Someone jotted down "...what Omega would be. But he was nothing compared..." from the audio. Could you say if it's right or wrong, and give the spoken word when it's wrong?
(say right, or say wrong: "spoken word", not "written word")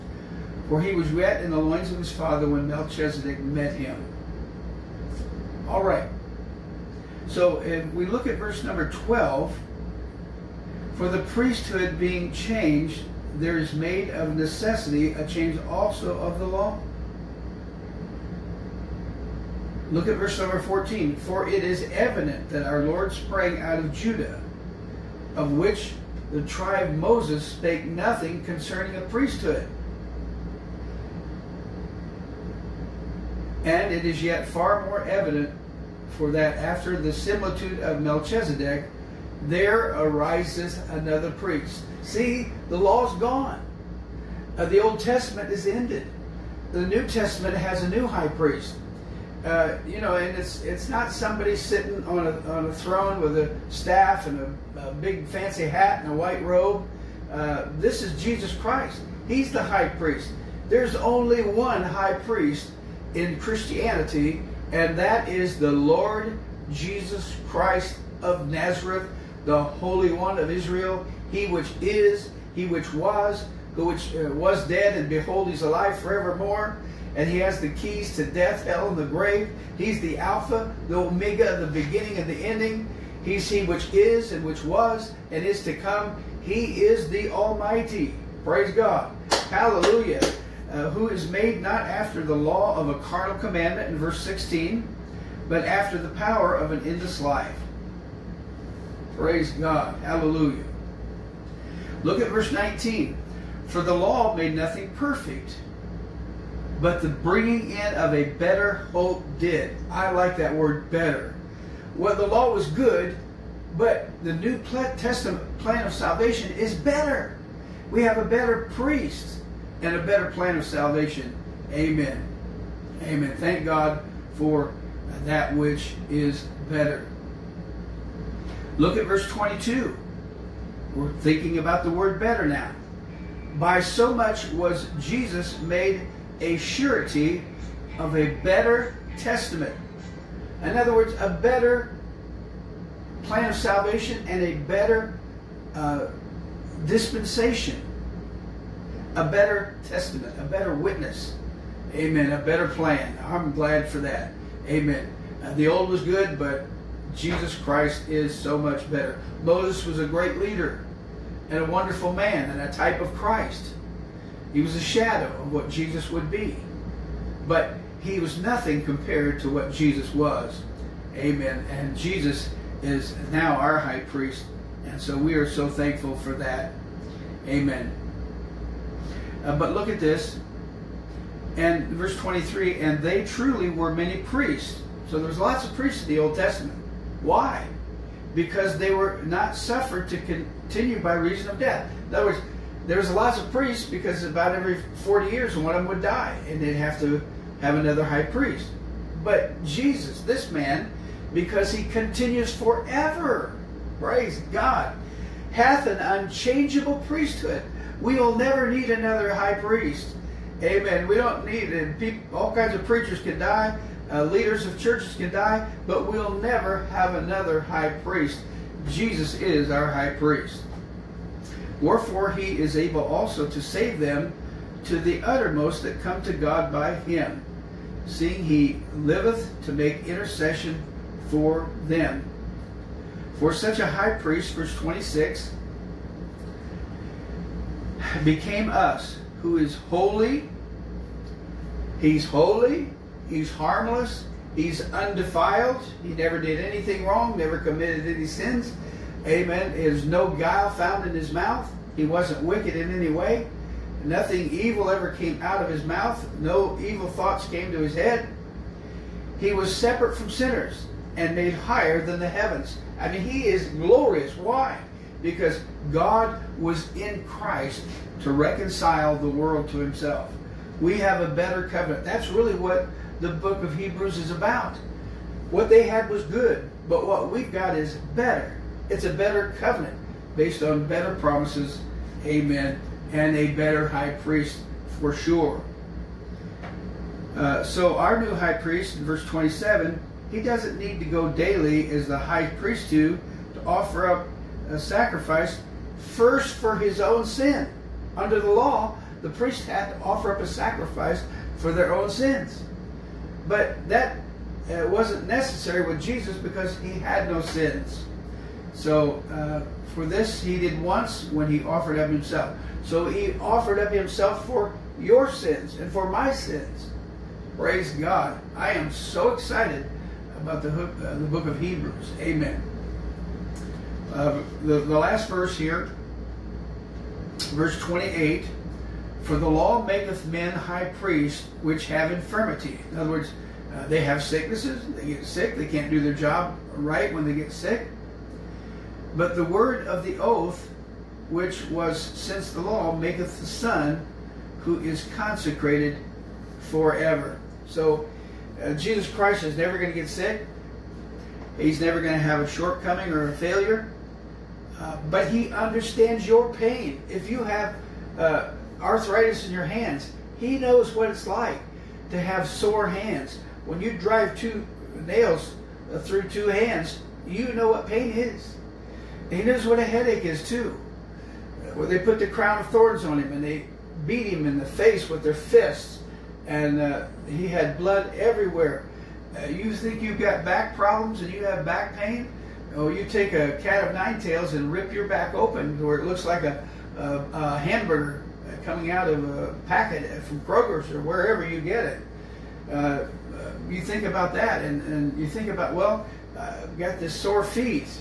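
wrong: "Jesus", not "Omega".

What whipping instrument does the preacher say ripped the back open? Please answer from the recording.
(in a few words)
cat of nine tails.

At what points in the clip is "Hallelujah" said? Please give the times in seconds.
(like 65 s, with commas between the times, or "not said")
89 s, 100 s.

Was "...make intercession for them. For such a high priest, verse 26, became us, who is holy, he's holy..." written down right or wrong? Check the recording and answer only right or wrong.
right.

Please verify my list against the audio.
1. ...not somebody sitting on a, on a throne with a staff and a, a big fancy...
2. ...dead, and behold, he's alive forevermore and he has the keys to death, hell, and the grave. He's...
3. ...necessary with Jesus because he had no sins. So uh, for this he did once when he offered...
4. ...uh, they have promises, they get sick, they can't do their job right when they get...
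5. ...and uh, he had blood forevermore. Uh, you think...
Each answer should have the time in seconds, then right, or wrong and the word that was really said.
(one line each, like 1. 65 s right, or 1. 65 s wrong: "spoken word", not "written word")
1. 50 s right
2. 74 s right
3. 305 s right
4. 333 s wrong: "sicknesses", not "promises"
5. 376 s wrong: "everywhere", not "forevermore".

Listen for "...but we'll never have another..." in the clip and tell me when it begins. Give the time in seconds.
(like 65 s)
215 s.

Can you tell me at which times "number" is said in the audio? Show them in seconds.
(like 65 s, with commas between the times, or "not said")
8 s, 20 s.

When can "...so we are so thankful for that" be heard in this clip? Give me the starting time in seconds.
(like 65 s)
175 s.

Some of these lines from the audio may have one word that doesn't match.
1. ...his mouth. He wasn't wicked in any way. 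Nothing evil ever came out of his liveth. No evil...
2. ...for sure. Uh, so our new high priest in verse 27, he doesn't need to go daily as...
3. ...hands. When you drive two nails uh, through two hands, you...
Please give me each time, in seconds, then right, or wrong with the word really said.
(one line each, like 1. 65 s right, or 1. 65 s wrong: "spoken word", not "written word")
1. 251 s wrong: "mouth", not "liveth"
2. 285 s right
3. 362 s right.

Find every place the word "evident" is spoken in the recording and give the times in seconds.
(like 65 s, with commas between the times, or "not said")
21 s, 35 s.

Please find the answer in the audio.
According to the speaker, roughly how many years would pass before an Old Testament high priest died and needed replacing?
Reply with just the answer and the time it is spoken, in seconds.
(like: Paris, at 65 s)
40, at 195 s.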